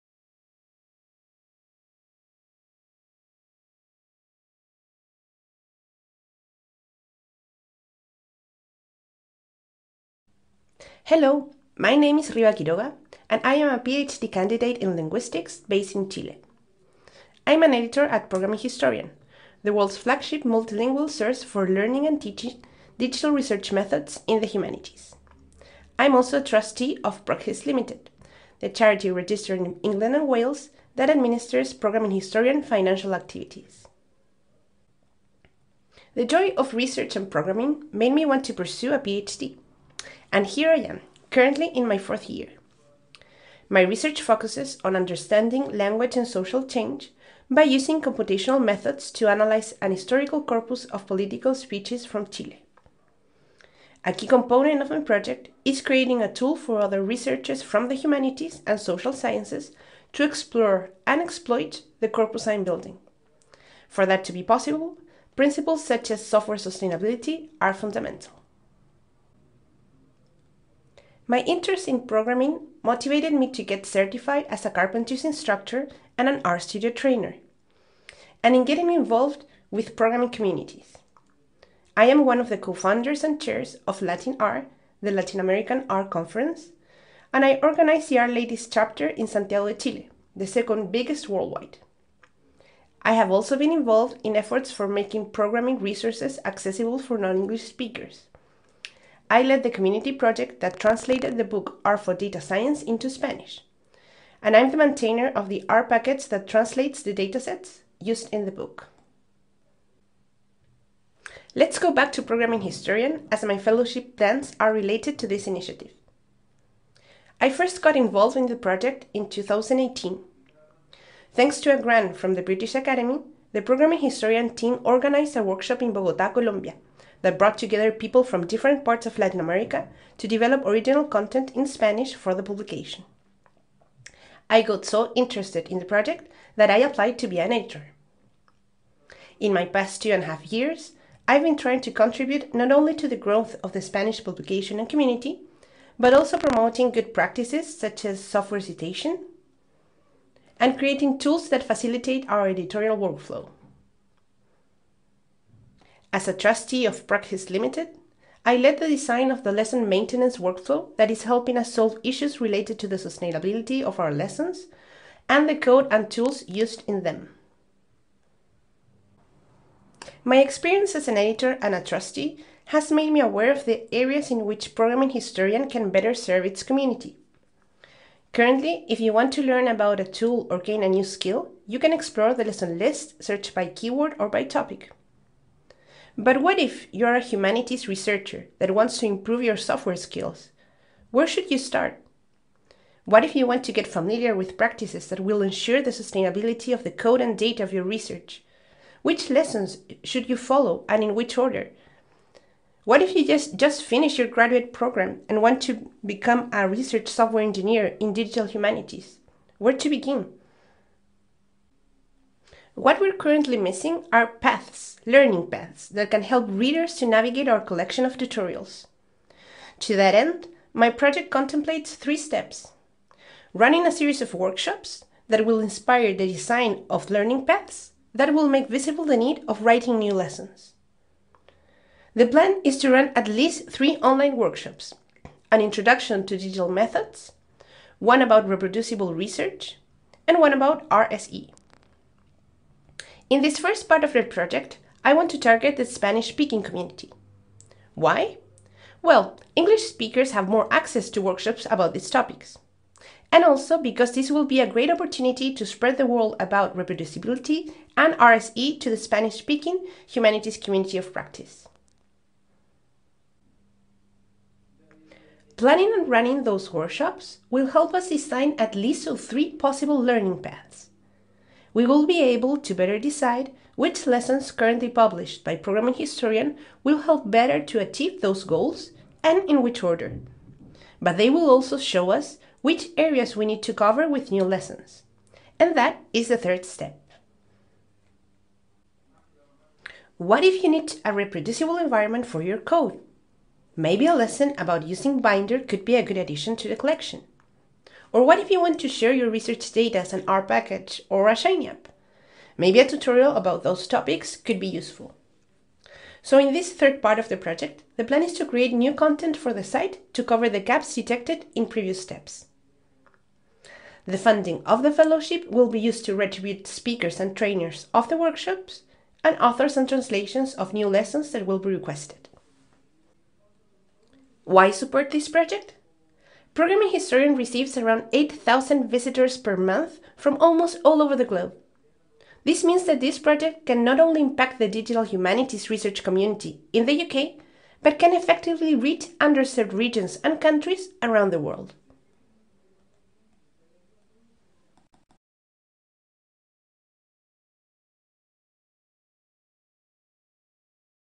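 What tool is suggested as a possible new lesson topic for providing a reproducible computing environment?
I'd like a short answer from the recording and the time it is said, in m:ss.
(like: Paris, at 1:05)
Binder, at 4:55.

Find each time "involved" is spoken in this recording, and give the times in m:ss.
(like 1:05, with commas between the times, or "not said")
1:18, 1:33, 1:57.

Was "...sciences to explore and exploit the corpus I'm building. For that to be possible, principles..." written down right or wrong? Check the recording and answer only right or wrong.
right.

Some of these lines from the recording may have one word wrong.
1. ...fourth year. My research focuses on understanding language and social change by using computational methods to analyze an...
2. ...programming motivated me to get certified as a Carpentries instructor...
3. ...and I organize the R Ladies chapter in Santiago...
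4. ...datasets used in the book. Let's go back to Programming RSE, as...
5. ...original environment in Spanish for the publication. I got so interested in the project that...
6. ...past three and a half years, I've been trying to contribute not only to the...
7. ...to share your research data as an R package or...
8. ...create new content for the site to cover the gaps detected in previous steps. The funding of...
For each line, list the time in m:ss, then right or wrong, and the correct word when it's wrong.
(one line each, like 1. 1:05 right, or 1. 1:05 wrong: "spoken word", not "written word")
1. 0:41 right
2. 1:12 right
3. 1:27 right
4. 1:47 wrong: "Historian", not "RSE"
5. 2:10 wrong: "content", not "environment"
6. 2:19 wrong: "two", not "three"
7. 4:58 right
8. 5:08 right.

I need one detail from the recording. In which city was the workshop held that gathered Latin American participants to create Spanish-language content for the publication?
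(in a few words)
Bogota.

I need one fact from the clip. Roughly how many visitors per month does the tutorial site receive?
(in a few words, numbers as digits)
8,000.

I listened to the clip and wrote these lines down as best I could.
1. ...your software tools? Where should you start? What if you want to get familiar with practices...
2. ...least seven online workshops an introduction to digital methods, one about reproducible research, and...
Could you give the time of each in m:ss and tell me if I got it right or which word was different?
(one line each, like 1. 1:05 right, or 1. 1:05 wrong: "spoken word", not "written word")
1. 3:09 wrong: "skills", not "tools"
2. 3:53 wrong: "three", not "seven".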